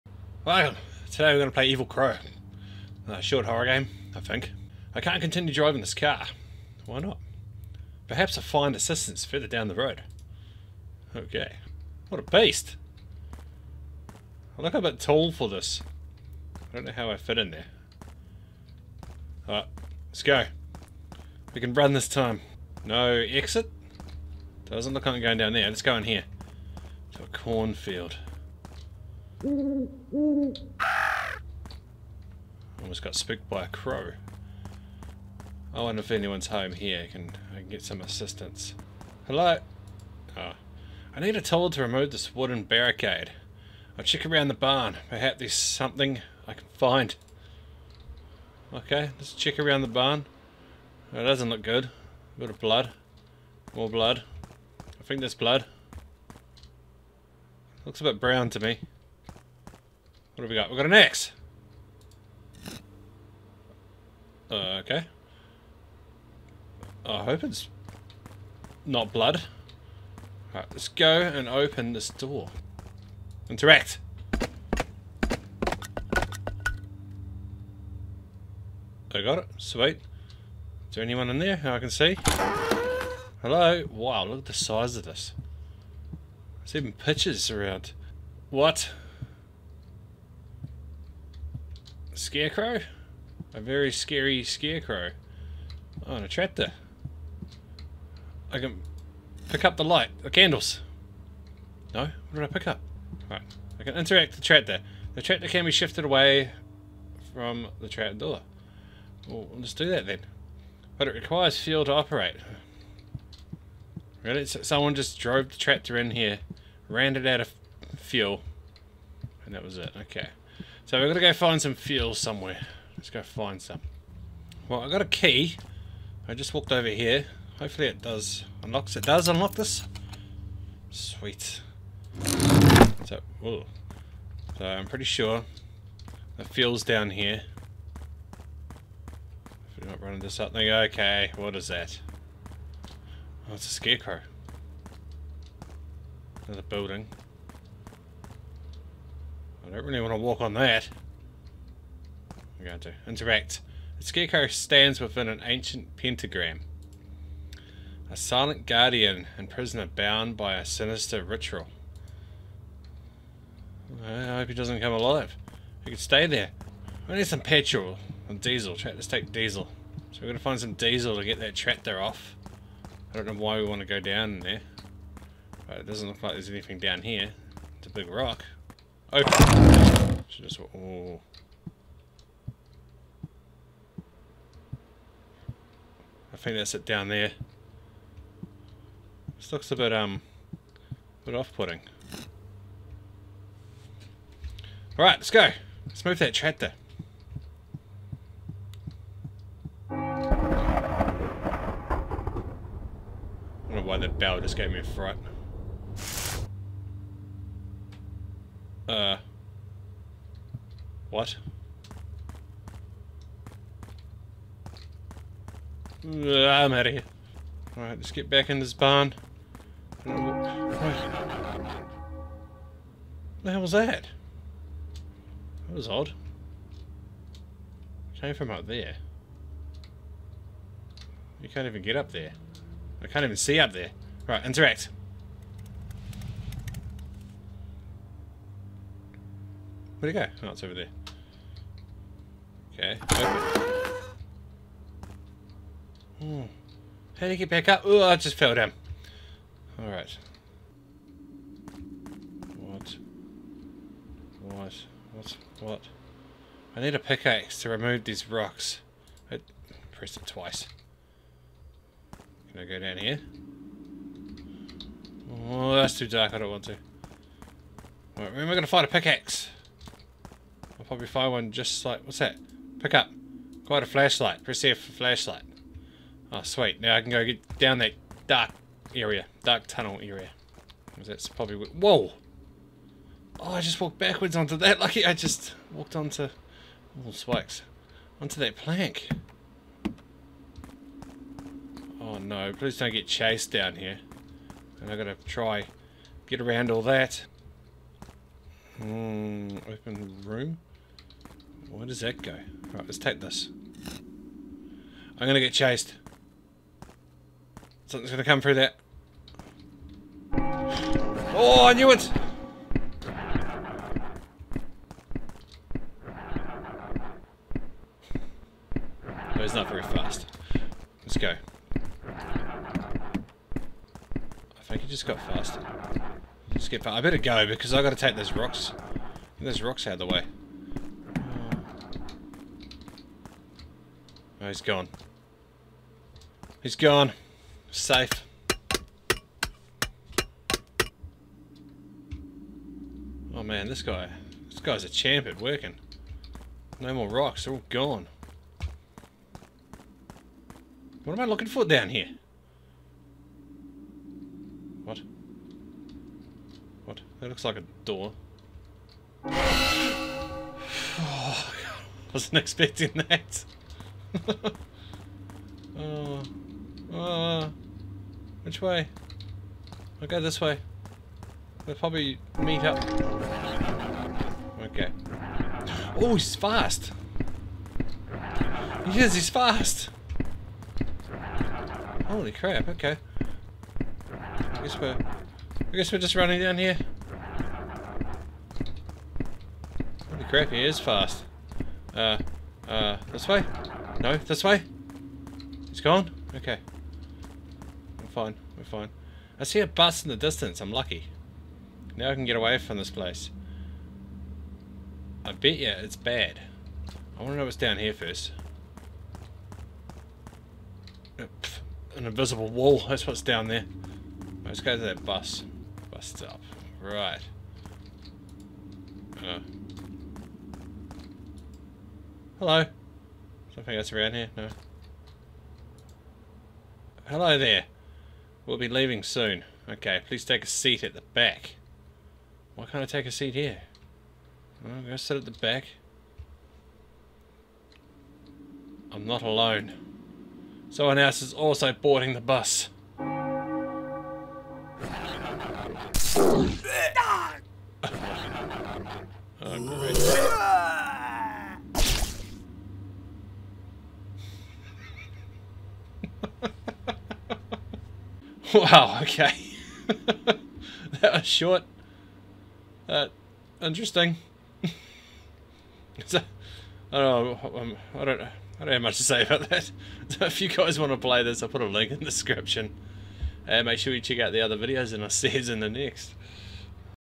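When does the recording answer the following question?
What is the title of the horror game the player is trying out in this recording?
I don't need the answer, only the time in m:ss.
0:01.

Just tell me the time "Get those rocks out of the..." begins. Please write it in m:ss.
5:29.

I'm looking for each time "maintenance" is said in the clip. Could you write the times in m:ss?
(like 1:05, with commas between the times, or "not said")
not said.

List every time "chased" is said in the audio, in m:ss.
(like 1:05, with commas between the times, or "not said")
4:53, 5:05.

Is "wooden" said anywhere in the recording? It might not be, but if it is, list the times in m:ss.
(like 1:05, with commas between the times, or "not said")
0:42.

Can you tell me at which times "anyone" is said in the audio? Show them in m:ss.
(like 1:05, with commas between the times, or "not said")
0:36, 1:21.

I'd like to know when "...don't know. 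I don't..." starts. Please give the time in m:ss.
7:48.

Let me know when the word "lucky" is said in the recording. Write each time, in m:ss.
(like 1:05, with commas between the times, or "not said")
4:44, 6:40.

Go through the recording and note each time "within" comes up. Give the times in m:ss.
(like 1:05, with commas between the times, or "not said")
2:34.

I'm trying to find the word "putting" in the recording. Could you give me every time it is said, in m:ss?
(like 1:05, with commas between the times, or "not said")
3:11.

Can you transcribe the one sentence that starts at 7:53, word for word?
And make sure you check out the other videos, and I'll see you in the next.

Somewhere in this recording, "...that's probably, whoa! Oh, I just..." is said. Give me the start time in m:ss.
4:41.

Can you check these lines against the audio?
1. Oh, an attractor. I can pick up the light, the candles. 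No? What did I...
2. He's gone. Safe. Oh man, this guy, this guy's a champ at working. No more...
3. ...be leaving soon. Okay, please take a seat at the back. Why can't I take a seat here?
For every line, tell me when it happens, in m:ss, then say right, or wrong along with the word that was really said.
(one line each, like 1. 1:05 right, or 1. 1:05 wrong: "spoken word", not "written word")
1. 1:36 right
2. 5:36 right
3. 7:08 right.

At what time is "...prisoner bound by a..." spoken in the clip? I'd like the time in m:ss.
2:39.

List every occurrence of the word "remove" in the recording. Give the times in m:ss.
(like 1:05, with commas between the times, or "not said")
0:41, 4:17.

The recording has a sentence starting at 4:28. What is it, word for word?
when we're going to find a pickaxe.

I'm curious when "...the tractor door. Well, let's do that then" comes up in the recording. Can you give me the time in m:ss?
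1:47.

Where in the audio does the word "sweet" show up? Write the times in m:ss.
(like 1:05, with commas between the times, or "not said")
1:19, 2:10, 4:36.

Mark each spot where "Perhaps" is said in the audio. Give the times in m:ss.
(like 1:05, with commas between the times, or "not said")
0:08, 0:45.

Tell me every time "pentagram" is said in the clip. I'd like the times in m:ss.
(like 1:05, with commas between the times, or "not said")
2:35.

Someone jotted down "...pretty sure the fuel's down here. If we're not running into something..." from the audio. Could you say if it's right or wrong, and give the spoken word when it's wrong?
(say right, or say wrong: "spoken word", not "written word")
right.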